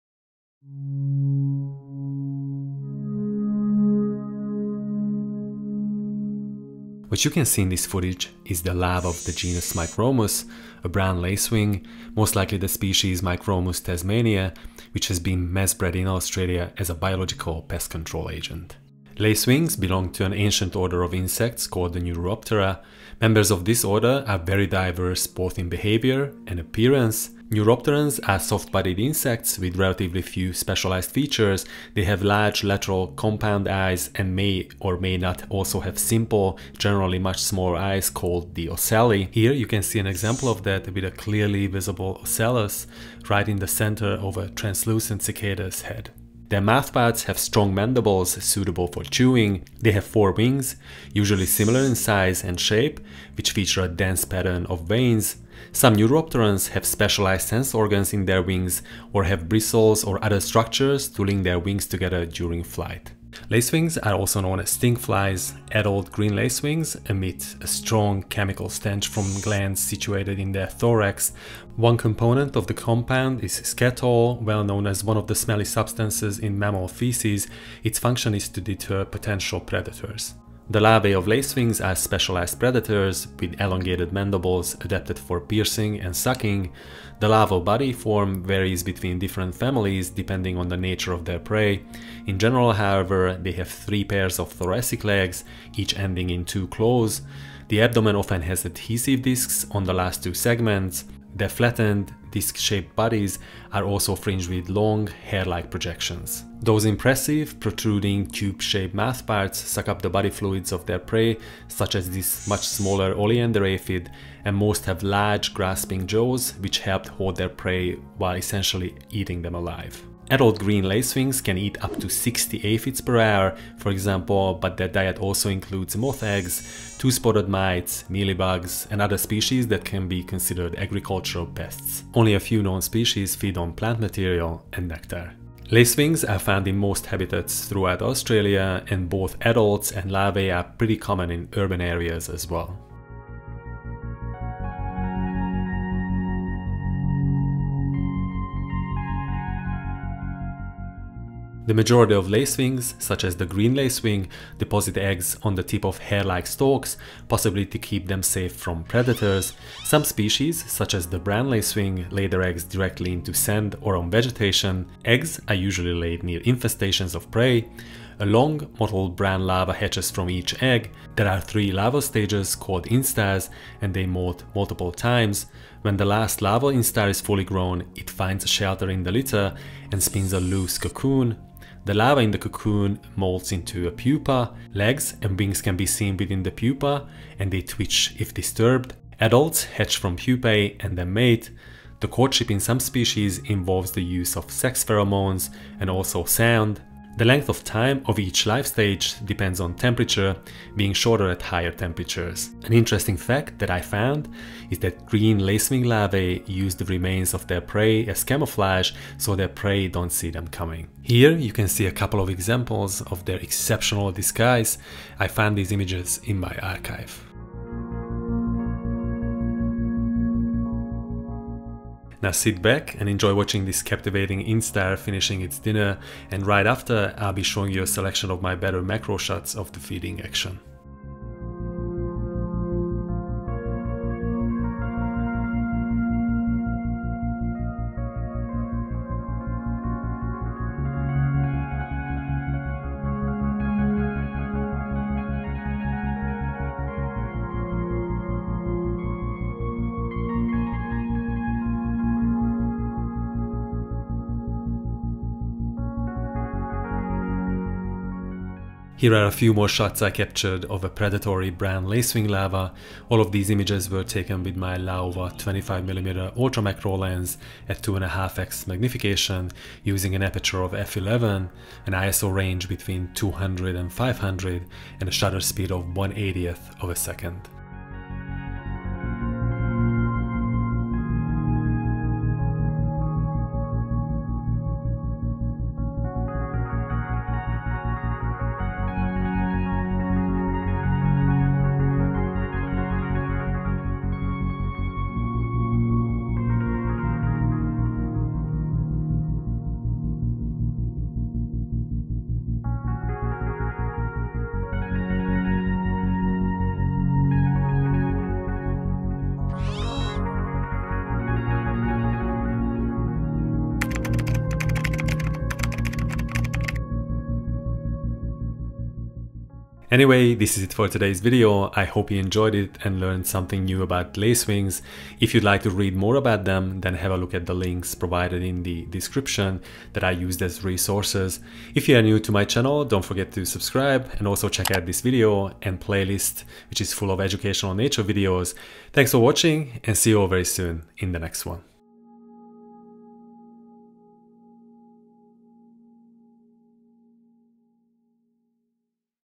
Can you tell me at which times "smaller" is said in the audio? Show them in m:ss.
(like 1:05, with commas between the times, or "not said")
0:37, 1:52.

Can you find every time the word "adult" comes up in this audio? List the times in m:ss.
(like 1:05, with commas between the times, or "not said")
1:05, 2:00, 2:19, 3:09.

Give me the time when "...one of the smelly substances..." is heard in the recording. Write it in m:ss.
1:15.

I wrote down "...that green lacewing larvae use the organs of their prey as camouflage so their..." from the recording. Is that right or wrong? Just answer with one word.
wrong.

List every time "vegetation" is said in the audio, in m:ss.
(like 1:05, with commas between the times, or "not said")
2:44.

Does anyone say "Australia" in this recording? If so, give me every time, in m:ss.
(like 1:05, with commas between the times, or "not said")
0:16, 2:18.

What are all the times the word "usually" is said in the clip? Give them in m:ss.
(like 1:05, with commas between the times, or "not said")
0:51, 2:45.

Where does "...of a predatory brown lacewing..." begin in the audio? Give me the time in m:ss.
4:20.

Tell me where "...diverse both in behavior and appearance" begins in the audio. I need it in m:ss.
0:24.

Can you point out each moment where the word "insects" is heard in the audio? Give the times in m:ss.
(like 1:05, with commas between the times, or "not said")
0:21, 0:28.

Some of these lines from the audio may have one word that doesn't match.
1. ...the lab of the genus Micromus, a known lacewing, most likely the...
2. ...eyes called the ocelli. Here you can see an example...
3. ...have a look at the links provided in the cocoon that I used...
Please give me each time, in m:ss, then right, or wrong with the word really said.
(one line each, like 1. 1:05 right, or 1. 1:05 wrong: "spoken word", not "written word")
1. 0:08 wrong: "brown", not "known"
2. 0:37 right
3. 5:26 wrong: "description", not "cocoon".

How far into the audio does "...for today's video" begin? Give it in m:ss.
5:20.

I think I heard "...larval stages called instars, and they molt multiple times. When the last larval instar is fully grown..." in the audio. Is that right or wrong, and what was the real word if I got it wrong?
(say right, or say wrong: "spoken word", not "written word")
right.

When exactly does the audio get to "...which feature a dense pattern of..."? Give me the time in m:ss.
0:53.